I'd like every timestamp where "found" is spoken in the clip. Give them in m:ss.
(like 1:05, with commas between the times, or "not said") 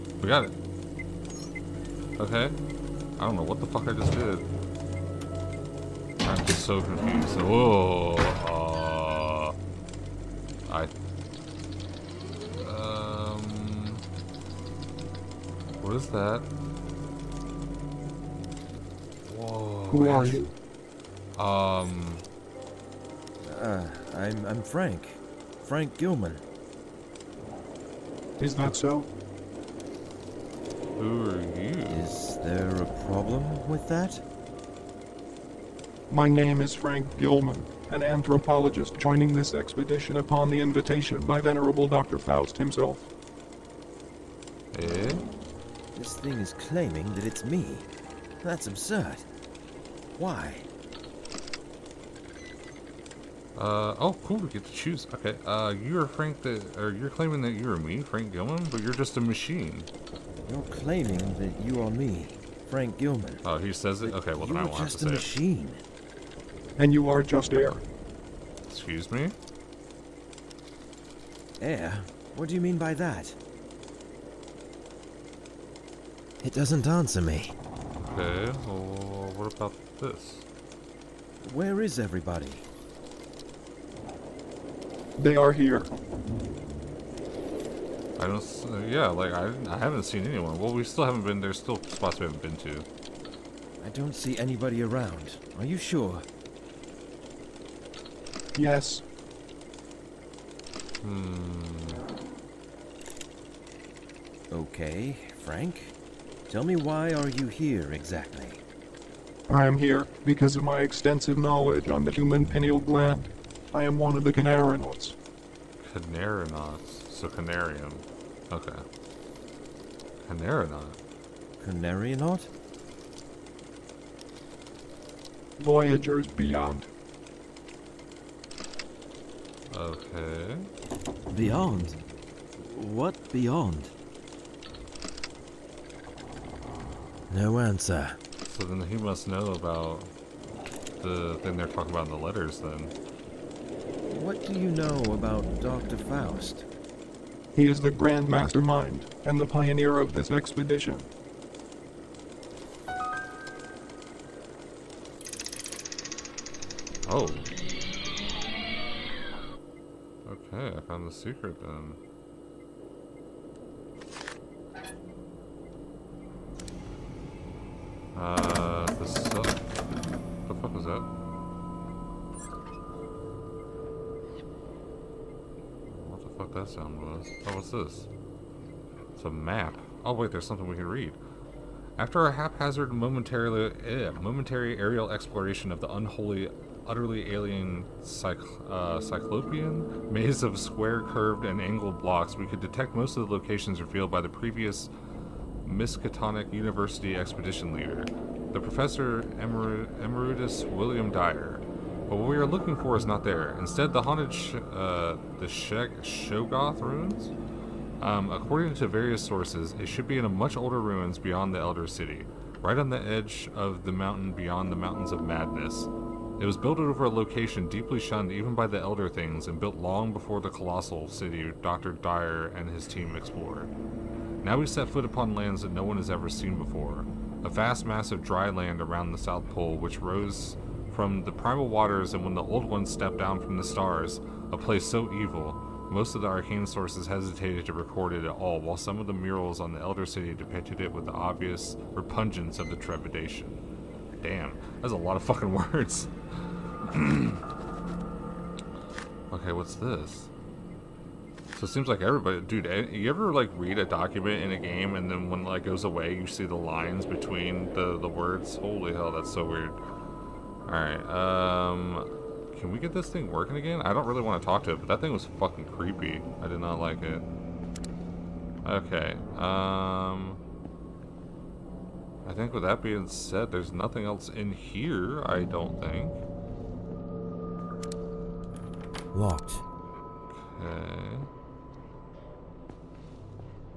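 2:40.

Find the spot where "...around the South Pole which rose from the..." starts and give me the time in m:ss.
3:48.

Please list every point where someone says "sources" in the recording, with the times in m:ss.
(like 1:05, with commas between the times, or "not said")
3:29, 3:56.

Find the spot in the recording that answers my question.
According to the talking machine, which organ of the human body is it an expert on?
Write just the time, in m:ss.
1:52.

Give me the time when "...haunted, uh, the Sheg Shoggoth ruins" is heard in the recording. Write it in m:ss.
3:24.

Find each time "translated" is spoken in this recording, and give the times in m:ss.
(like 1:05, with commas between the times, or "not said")
not said.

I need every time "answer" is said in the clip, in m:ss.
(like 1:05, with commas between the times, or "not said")
1:16, 2:17.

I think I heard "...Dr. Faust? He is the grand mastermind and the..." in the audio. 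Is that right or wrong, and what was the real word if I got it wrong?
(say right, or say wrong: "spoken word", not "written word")
right.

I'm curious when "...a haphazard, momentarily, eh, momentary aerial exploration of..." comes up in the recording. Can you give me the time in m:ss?
3:02.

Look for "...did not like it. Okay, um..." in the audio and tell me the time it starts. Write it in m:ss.
4:26.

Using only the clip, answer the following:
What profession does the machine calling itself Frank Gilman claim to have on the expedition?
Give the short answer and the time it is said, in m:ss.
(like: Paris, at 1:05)
Anthropologist, at 0:37.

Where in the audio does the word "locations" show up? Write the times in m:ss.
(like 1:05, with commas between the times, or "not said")
3:13, 3:37.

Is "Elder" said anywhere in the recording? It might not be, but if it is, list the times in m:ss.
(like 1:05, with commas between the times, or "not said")
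3:31, 3:38, 3:59.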